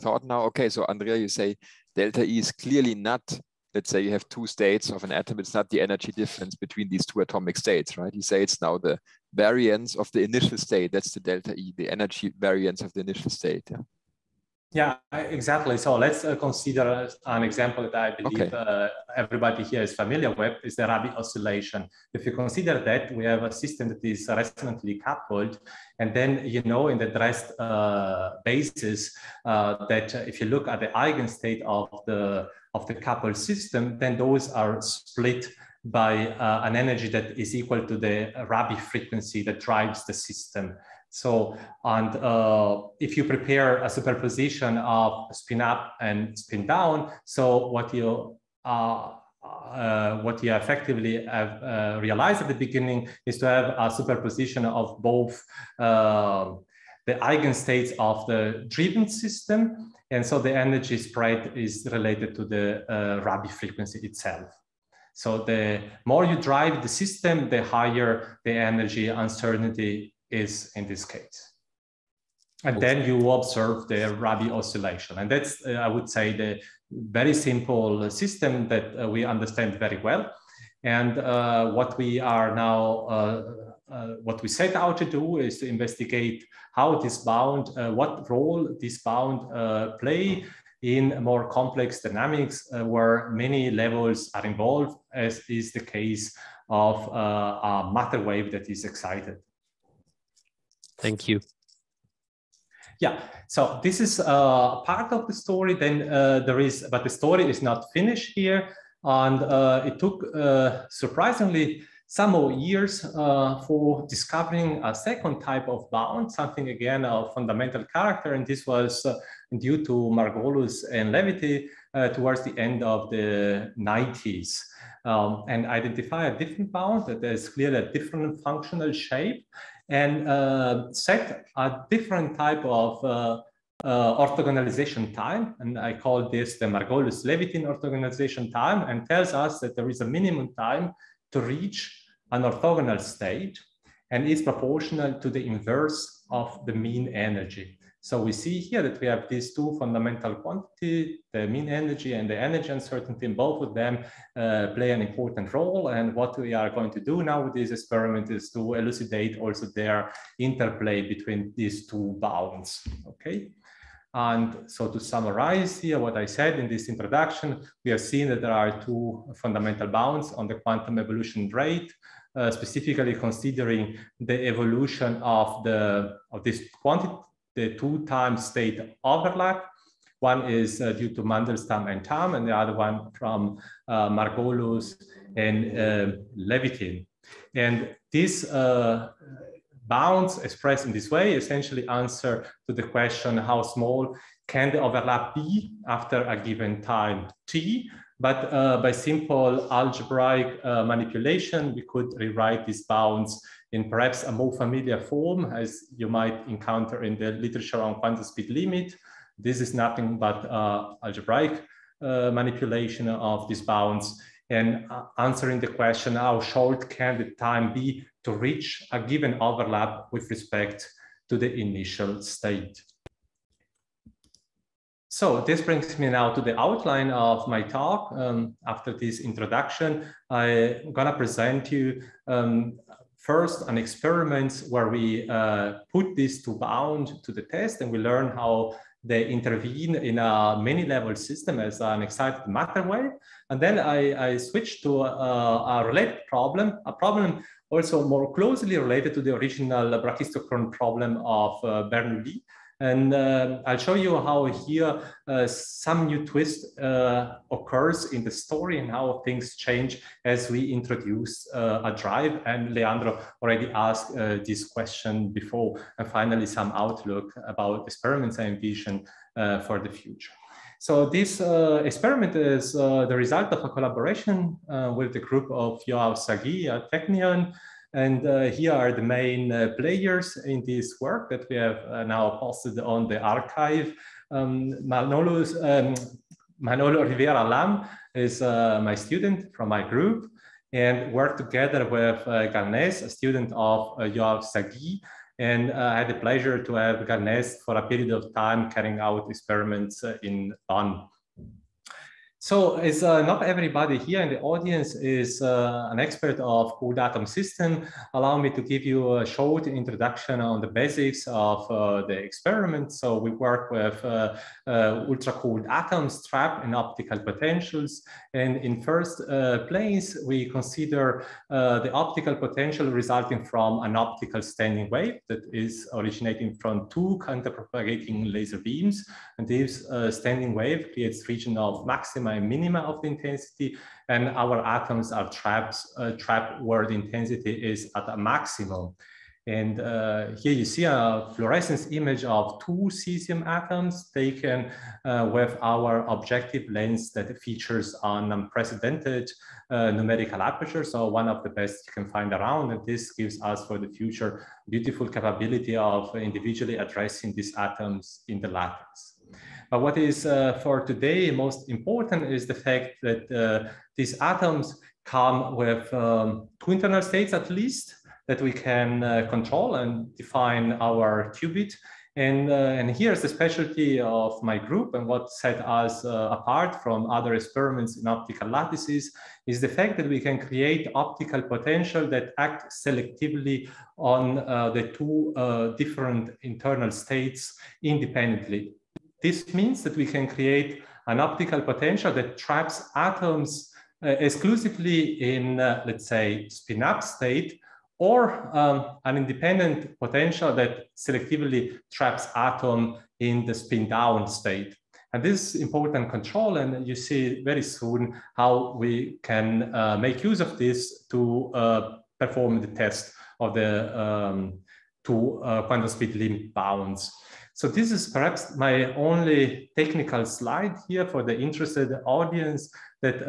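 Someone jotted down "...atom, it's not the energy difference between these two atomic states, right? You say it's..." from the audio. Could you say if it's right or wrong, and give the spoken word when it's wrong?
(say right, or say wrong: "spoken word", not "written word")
right.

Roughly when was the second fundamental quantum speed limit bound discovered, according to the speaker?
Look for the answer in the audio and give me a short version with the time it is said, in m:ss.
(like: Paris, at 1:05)
end of the 90s, at 2:02.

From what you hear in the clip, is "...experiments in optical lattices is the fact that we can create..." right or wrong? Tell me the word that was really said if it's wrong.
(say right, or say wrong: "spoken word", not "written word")
right.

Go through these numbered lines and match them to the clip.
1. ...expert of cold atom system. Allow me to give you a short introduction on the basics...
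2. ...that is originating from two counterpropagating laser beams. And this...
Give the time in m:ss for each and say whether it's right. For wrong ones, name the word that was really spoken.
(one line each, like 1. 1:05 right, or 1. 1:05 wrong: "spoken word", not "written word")
1. 5:05 right
2. 5:25 right.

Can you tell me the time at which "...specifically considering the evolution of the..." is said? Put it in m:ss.
2:52.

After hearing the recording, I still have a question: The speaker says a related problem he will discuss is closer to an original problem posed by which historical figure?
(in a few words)
Bernoulli.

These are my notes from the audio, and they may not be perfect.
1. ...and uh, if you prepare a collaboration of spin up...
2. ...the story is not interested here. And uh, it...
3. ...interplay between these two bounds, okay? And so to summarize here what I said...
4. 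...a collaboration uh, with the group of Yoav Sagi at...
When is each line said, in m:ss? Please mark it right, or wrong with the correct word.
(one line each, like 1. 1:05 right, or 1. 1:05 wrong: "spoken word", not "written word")
1. 0:41 wrong: "superposition", not "collaboration"
2. 1:47 wrong: "finished", not "interested"
3. 2:40 right
4. 4:33 right.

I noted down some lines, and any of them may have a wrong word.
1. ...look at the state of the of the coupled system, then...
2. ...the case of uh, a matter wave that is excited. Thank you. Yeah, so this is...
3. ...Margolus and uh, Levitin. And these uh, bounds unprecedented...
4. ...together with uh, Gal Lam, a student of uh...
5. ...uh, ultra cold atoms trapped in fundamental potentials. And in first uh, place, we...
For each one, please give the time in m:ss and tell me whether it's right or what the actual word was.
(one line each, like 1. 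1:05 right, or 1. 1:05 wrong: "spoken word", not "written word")
1. 0:30 wrong: "eigenstate", not "state"
2. 1:35 right
3. 3:04 wrong: "expressed", not "unprecedented"
4. 4:51 wrong: "Ness", not "Lam"
5. 5:14 wrong: "optical", not "fundamental".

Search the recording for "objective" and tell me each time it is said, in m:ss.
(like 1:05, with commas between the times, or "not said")
5:46.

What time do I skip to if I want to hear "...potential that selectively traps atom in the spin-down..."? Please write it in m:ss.
6:39.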